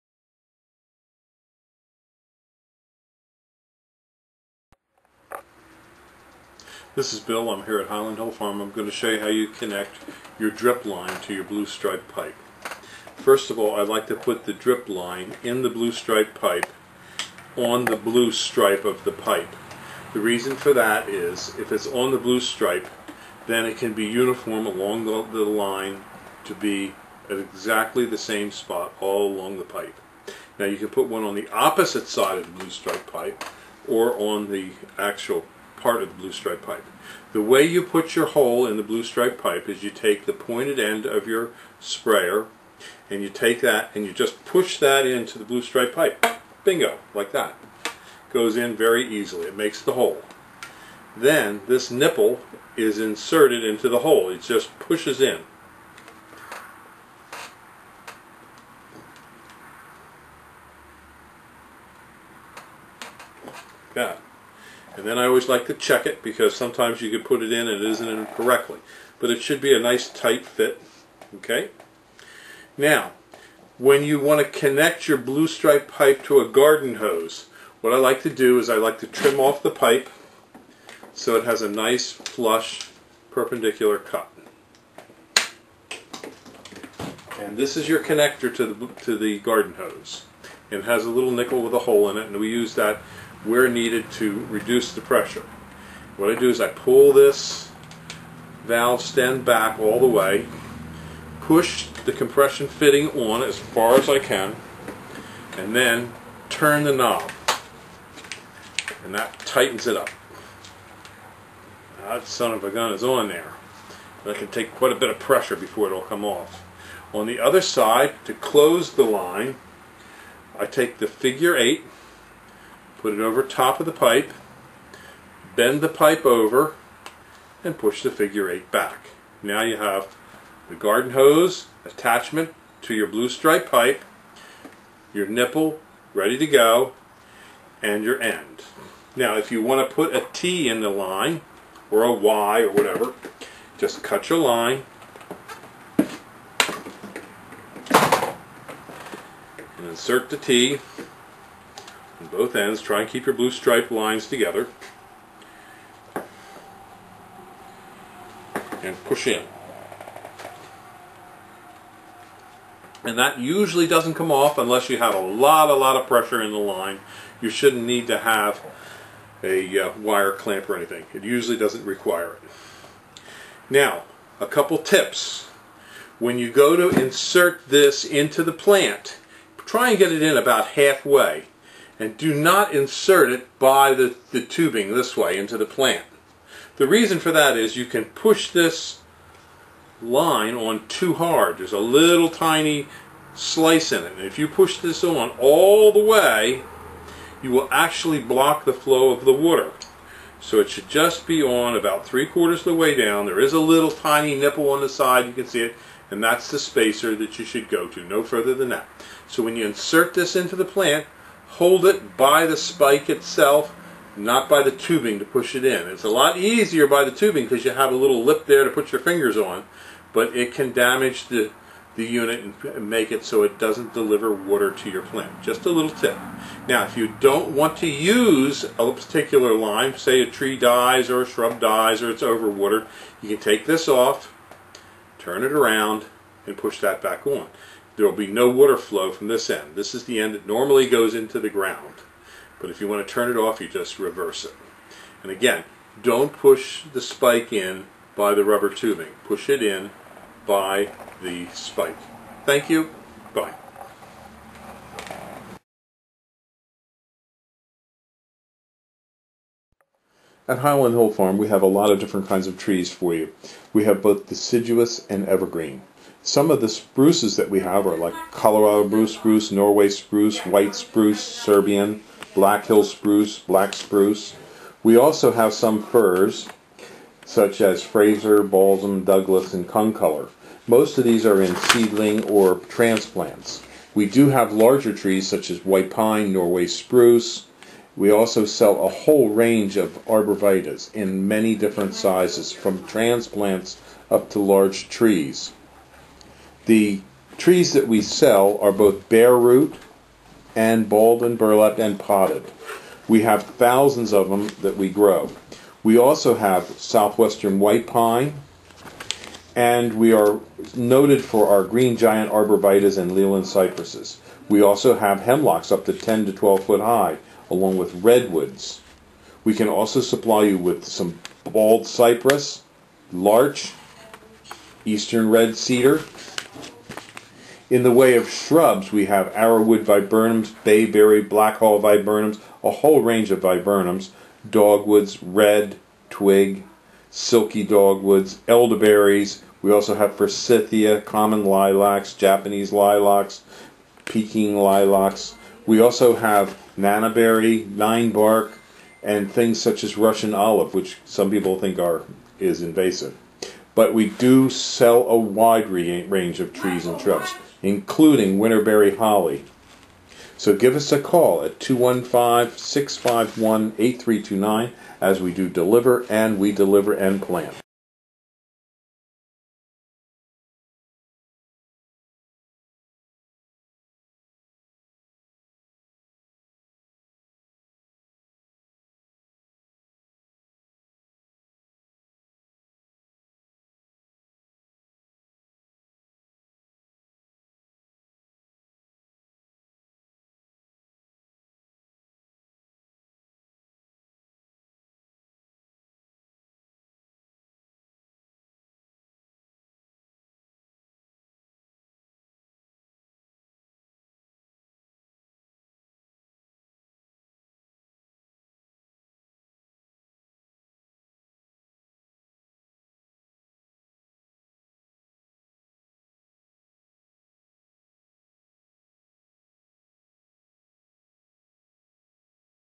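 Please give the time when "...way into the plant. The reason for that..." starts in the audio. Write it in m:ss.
3:05.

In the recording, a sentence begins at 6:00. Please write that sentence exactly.
So give us a call at 215 651 8329 as we do deliver and we deliver and plant.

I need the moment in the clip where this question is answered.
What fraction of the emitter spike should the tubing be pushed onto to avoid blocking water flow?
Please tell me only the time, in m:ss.
3:22.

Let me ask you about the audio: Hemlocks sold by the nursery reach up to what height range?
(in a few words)
10 to 12 feet.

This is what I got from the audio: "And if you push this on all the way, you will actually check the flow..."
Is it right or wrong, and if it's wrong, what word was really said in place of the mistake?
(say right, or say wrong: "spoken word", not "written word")
wrong: "block", not "check".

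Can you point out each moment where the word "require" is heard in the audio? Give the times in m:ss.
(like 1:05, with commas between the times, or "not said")
2:51.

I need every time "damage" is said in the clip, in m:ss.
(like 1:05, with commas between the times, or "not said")
3:40.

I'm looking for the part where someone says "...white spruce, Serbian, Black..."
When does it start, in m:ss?
4:30.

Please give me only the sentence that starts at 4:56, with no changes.
The trees that we sell are both bare root and balled and burlapped and potted.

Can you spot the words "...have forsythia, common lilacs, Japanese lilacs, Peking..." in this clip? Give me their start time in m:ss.
5:39.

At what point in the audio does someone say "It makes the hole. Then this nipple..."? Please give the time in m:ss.
0:49.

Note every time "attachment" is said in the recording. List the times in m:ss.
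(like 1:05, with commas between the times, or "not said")
2:11.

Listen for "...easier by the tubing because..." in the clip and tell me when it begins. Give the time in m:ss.
3:36.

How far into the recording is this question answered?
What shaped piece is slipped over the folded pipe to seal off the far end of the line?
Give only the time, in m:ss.
2:01.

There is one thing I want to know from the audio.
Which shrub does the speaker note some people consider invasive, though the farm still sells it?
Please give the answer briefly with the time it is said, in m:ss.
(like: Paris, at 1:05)
Russian olive, at 5:49.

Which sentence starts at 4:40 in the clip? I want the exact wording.
Most of these are in seedling or transplants.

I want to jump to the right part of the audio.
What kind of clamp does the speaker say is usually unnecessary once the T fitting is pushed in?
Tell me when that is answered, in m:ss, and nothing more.
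2:49.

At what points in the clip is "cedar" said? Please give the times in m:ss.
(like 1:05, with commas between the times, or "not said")
5:25.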